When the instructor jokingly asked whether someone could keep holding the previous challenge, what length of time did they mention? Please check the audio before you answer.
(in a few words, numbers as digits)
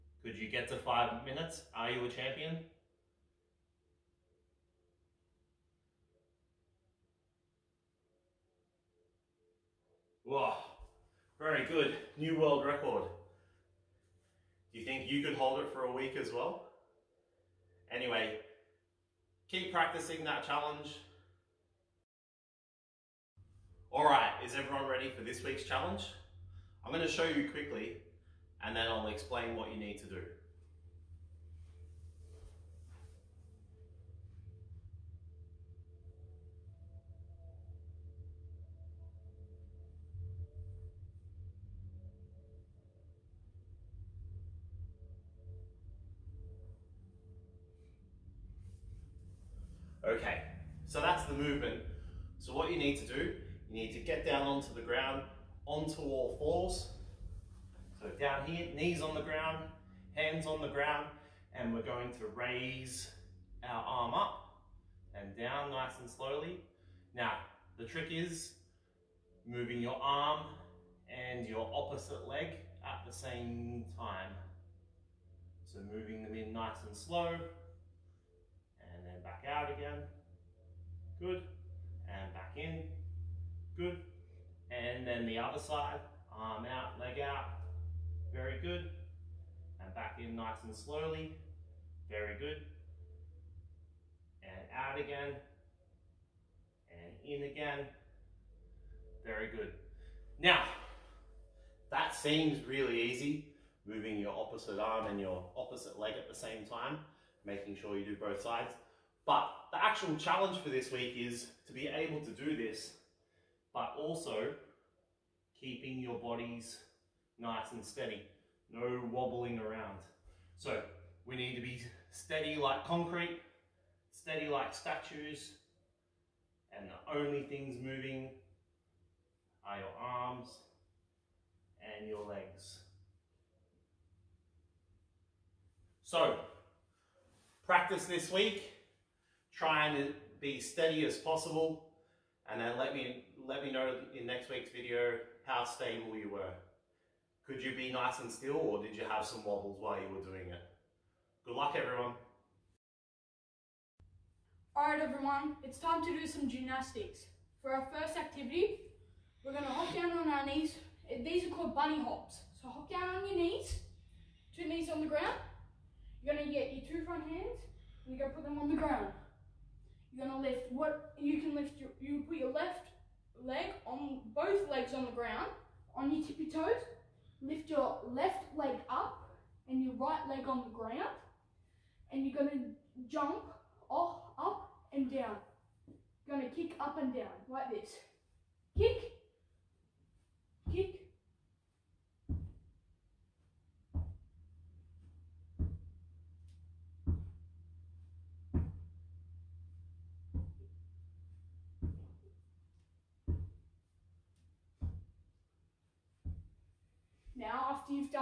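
a week.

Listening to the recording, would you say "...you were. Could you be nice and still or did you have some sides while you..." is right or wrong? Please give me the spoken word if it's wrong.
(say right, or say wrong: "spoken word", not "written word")
wrong: "wobbles", not "sides".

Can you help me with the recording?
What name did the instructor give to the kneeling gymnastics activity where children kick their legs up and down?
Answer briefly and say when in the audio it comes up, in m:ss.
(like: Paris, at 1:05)
bunny hops, at 2:41.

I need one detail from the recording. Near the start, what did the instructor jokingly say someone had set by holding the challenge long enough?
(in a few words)
new world record.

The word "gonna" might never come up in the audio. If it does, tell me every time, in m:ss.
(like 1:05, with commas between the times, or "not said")
0:26, 2:50, 3:02, 3:06.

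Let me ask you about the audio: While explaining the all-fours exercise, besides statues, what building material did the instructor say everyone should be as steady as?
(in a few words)
concrete.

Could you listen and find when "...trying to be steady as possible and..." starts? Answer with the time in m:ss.
2:19.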